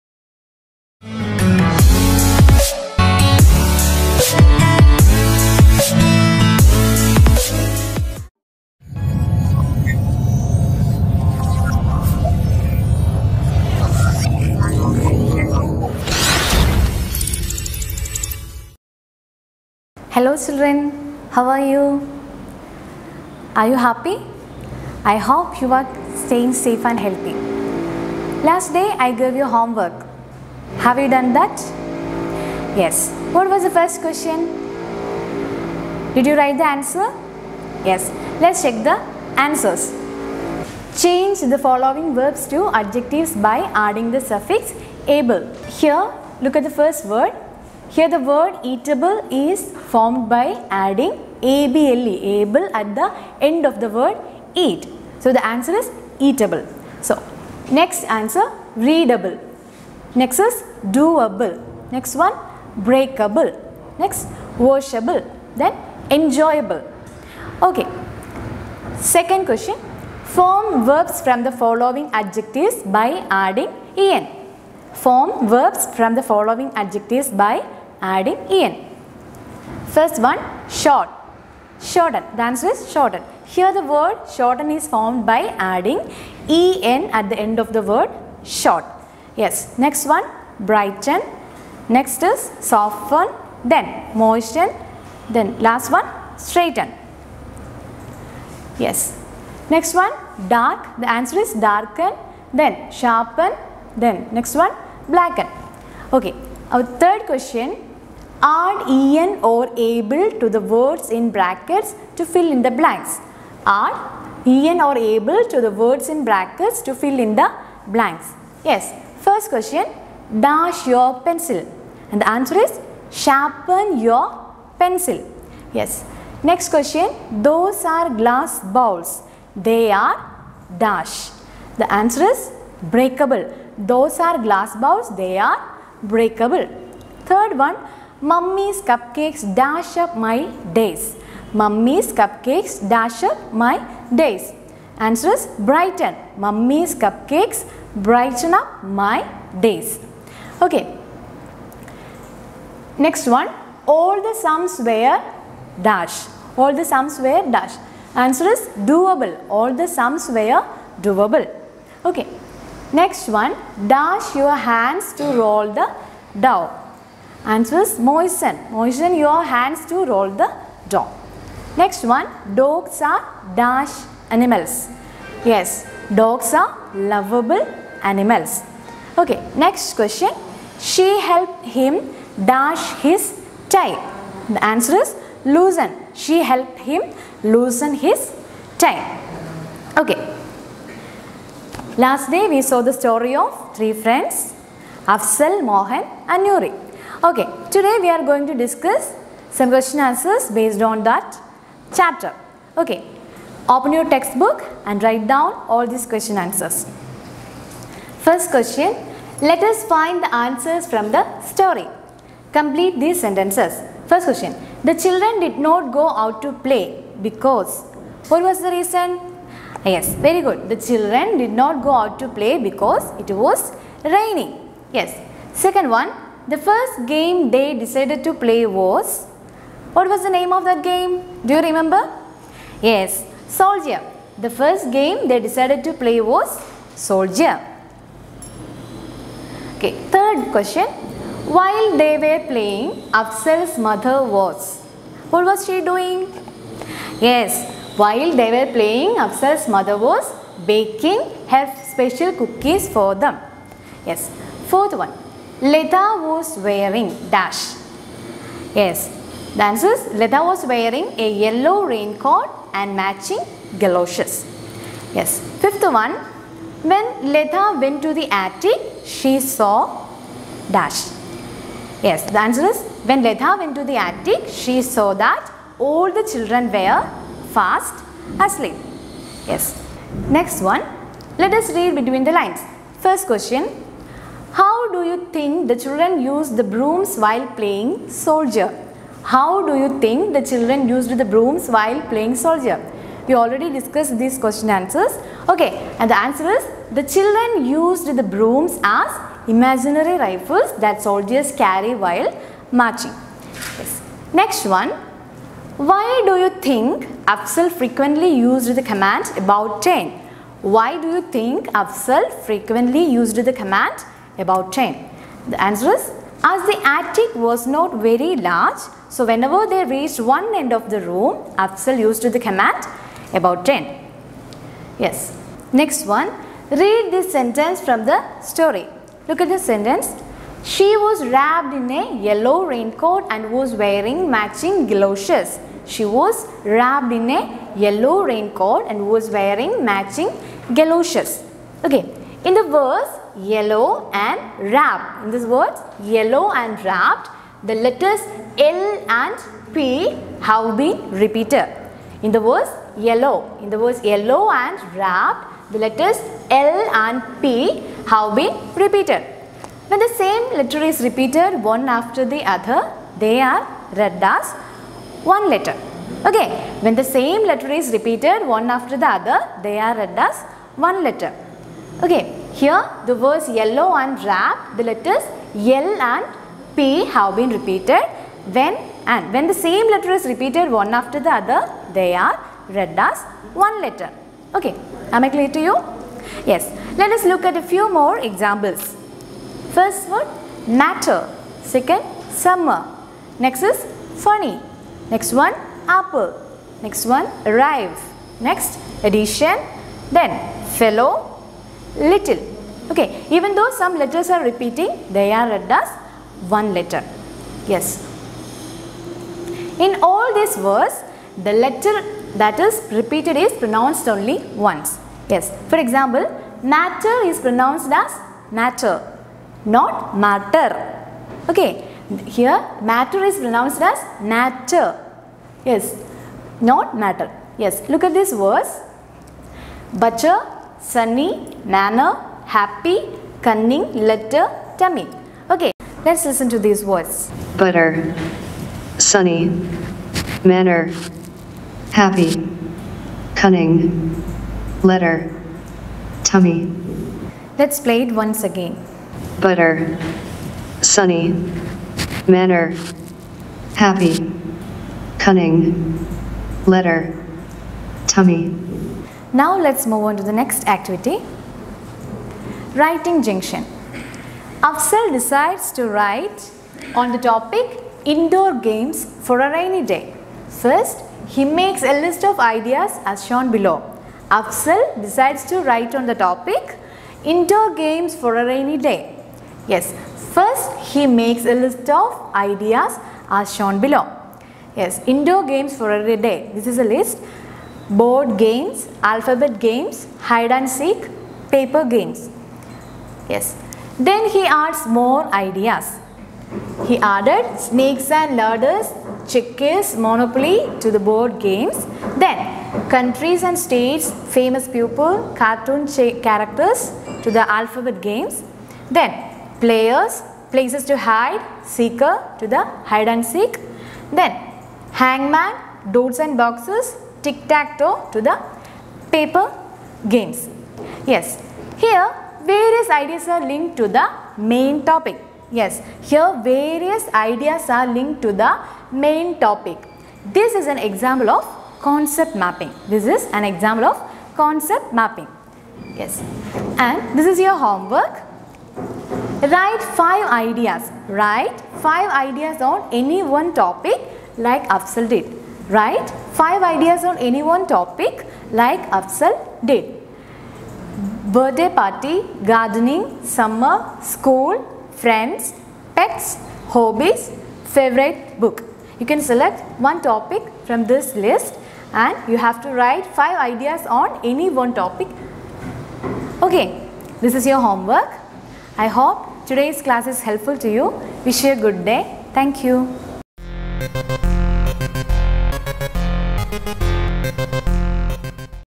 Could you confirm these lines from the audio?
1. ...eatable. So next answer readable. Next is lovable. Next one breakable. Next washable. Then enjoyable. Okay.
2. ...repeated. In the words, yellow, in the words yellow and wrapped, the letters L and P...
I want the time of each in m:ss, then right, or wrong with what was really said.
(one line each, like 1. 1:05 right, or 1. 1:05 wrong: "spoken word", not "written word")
1. 0:56 wrong: "doable", not "lovable"
2. 5:51 right.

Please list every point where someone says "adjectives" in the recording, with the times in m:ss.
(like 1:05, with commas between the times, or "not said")
0:42, 1:12, 1:16.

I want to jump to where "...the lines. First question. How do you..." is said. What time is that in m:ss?
4:42.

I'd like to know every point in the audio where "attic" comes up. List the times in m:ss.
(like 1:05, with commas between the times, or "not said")
4:28, 4:33, 5:16.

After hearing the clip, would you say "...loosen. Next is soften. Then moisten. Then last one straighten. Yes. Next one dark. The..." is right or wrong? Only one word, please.
wrong.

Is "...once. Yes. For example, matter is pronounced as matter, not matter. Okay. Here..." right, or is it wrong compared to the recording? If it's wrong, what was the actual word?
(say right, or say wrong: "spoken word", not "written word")
right.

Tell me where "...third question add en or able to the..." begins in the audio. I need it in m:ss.
1:46.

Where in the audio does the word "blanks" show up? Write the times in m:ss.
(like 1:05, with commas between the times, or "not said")
1:52, 1:57.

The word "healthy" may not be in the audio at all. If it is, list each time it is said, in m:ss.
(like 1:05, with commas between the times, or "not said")
0:26.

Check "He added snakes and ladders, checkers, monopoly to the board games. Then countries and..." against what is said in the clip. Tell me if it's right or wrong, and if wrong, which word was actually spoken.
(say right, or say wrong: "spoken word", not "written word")
right.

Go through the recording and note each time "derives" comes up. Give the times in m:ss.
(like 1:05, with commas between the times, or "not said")
not said.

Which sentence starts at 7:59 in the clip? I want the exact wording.
Yes, first he makes a list of ideas as shown below.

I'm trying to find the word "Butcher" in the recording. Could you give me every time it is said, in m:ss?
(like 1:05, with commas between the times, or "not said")
7:09.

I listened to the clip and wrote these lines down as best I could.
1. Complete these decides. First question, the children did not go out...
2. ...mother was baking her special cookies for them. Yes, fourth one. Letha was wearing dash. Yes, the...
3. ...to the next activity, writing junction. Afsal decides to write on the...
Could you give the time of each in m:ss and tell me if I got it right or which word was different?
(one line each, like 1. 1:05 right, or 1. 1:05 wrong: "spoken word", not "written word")
1. 3:32 wrong: "sentences", not "decides"
2. 4:09 right
3. 7:40 right.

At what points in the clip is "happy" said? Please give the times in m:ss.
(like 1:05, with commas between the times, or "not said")
0:23, 7:12, 7:21, 7:33.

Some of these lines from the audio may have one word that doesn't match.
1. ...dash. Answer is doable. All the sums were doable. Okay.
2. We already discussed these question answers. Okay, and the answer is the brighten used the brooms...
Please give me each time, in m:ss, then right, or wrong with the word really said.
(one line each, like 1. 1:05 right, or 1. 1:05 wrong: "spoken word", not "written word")
1. 2:37 right
2. 4:53 wrong: "children", not "brighten".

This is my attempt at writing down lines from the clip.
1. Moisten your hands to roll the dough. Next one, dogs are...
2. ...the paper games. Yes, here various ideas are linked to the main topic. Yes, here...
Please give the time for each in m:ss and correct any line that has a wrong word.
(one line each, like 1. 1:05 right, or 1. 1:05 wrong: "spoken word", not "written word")
1. 2:48 right
2. 8:38 right.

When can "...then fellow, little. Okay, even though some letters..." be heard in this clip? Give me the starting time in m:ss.
6:40.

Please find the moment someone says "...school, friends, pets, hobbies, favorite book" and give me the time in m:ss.
9:14.